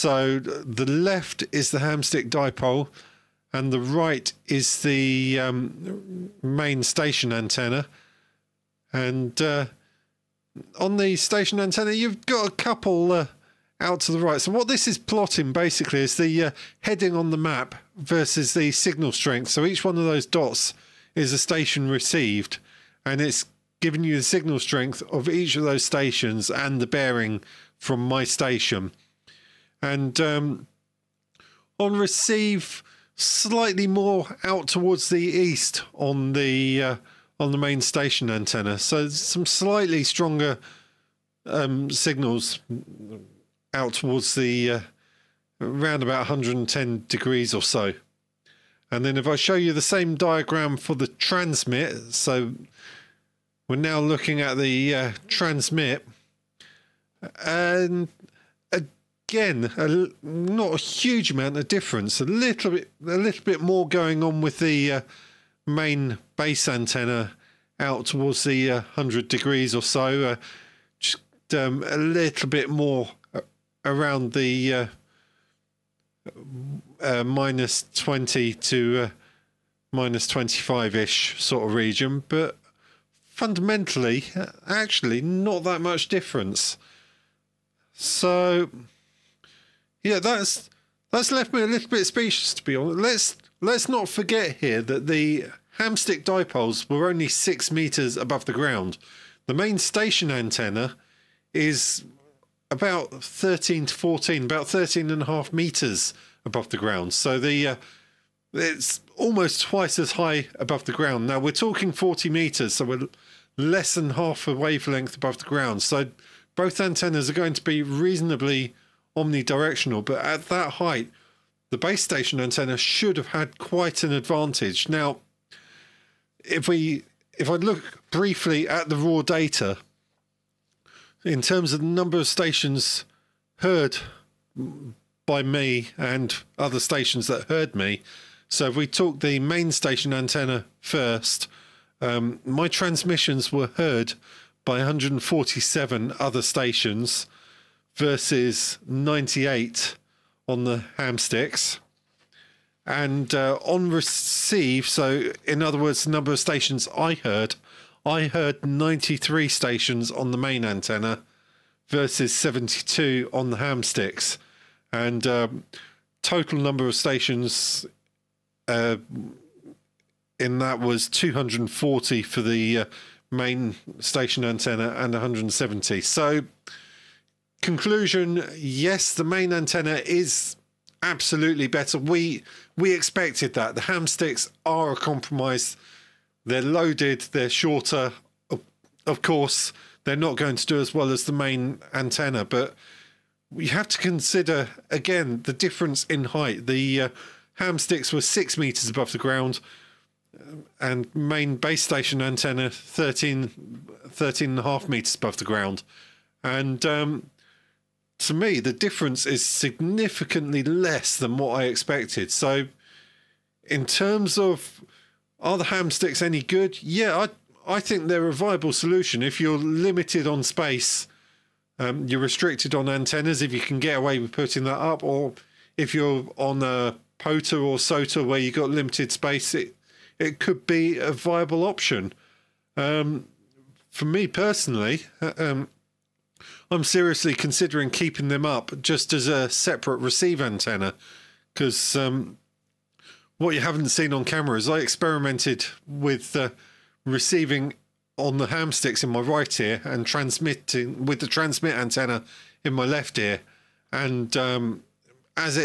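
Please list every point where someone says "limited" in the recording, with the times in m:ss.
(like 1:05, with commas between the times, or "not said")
3:39, 3:48.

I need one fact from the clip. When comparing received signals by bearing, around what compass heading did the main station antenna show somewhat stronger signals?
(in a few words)
110 degrees.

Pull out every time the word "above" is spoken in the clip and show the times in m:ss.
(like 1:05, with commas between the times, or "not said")
1:38, 1:46, 1:50, 1:55, 3:18, 3:25.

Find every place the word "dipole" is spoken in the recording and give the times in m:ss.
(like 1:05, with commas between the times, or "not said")
0:02, 1:36.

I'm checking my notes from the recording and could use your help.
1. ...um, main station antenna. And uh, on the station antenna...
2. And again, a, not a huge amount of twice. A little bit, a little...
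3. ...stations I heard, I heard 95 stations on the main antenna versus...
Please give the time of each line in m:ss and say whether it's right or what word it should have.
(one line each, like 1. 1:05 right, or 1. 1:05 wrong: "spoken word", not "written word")
1. 0:05 right
2. 0:57 wrong: "difference", not "twice"
3. 2:36 wrong: "93", not "95".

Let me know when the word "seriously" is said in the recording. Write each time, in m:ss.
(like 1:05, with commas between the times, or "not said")
3:56.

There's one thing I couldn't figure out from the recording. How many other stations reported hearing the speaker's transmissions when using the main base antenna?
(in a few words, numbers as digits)
147.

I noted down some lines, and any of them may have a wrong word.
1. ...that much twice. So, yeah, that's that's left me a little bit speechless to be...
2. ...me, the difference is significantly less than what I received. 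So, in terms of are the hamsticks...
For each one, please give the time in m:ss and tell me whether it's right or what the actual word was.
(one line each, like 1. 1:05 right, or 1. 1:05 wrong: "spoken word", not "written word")
1. 1:25 wrong: "difference", not "twice"
2. 3:28 wrong: "expected", not "received".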